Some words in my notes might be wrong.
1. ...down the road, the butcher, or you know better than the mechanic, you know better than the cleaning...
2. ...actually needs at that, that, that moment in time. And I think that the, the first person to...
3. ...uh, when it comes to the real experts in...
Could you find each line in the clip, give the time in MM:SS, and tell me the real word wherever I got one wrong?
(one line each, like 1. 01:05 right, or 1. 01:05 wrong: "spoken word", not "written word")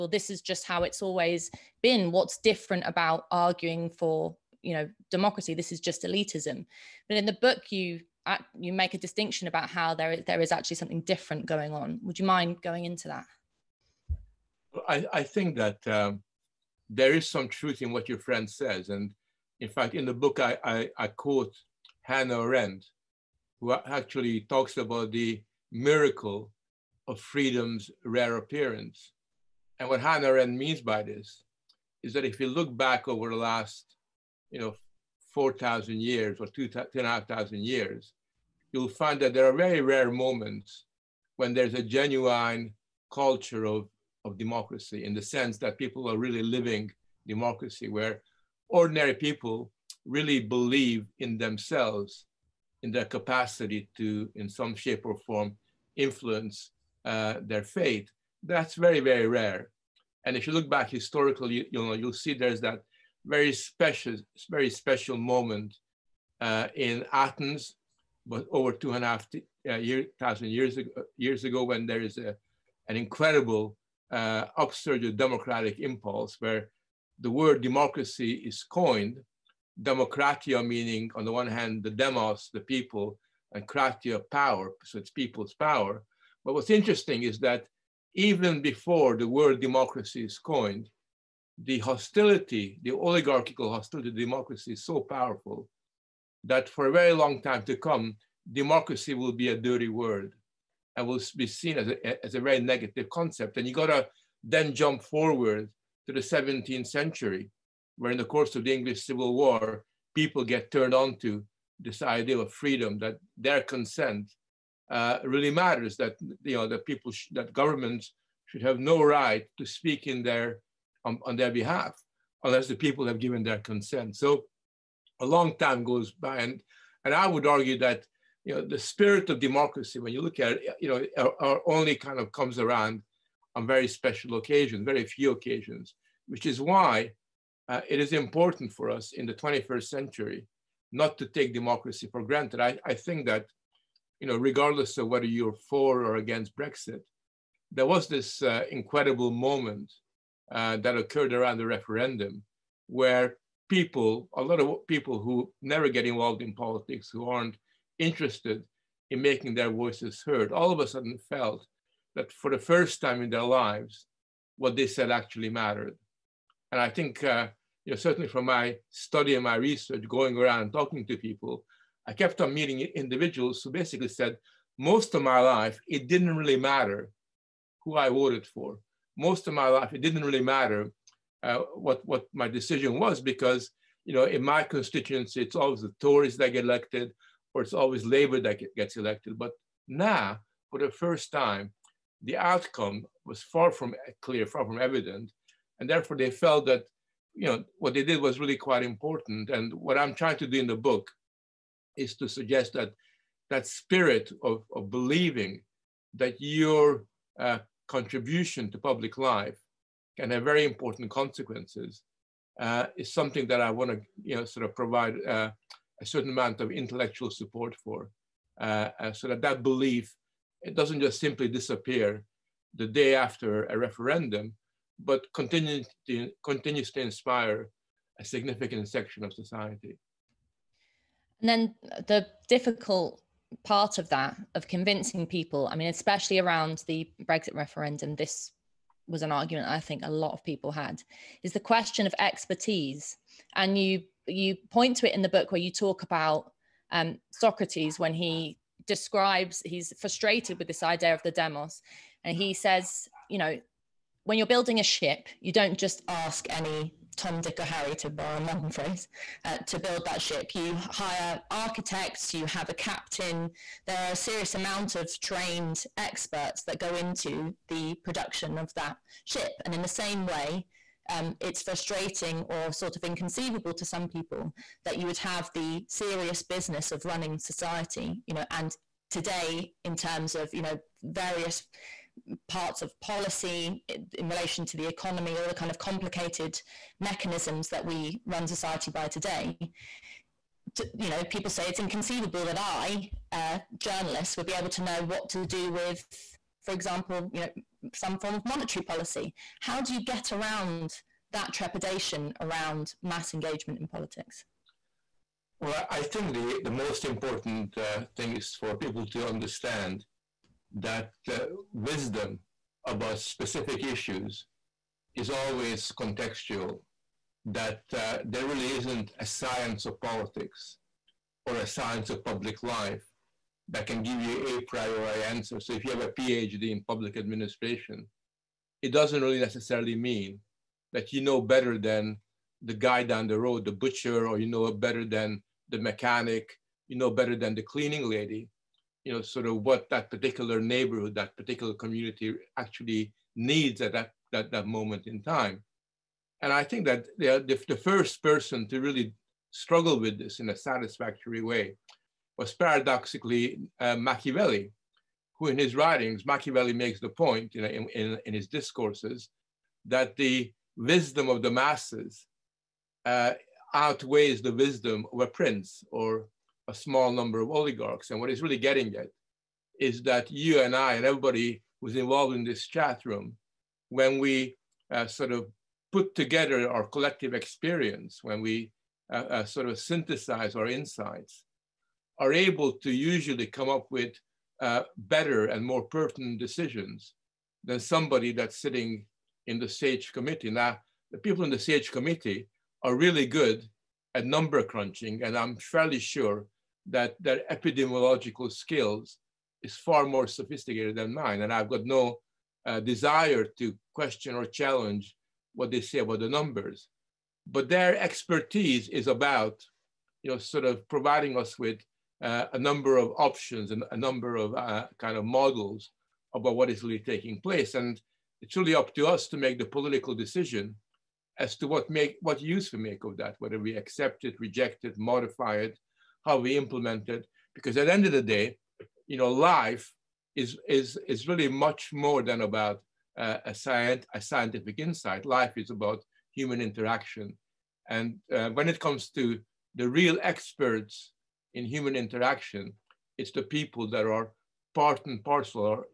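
1. 05:33 right
2. 05:42 right
3. 07:18 right.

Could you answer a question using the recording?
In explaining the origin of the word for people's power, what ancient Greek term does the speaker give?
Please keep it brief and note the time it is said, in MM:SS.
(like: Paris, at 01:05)
democratia, at 01:19.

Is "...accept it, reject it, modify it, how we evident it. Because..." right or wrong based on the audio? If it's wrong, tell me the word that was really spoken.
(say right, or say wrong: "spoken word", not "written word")
wrong: "implement", not "evident".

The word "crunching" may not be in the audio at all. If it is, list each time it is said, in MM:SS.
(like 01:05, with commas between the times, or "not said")
06:34.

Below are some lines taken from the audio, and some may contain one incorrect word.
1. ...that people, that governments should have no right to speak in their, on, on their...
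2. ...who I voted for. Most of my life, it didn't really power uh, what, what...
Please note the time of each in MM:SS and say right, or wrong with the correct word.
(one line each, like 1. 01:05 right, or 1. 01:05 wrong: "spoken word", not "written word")
1. 01:56 right
2. 02:57 wrong: "matter", not "power".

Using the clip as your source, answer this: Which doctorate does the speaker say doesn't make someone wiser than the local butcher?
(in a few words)
public administration.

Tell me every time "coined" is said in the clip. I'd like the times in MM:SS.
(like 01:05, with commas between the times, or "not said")
01:18, 01:30.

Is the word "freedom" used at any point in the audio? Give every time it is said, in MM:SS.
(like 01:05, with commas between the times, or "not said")
00:27, 01:52.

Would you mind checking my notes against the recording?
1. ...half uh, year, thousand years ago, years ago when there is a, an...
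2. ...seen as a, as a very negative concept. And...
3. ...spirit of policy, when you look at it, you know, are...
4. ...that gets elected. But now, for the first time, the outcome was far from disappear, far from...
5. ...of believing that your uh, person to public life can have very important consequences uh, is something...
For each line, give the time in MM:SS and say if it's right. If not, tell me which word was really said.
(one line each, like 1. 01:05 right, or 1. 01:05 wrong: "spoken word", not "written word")
1. 01:09 right
2. 01:41 right
3. 02:08 wrong: "democracy", not "policy"
4. 03:08 wrong: "clear", not "disappear"
5. 03:24 wrong: "contribution", not "person".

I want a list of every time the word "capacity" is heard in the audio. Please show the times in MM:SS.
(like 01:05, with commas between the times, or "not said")
00:53.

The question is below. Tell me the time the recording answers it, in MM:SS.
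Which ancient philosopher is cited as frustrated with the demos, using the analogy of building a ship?
04:07.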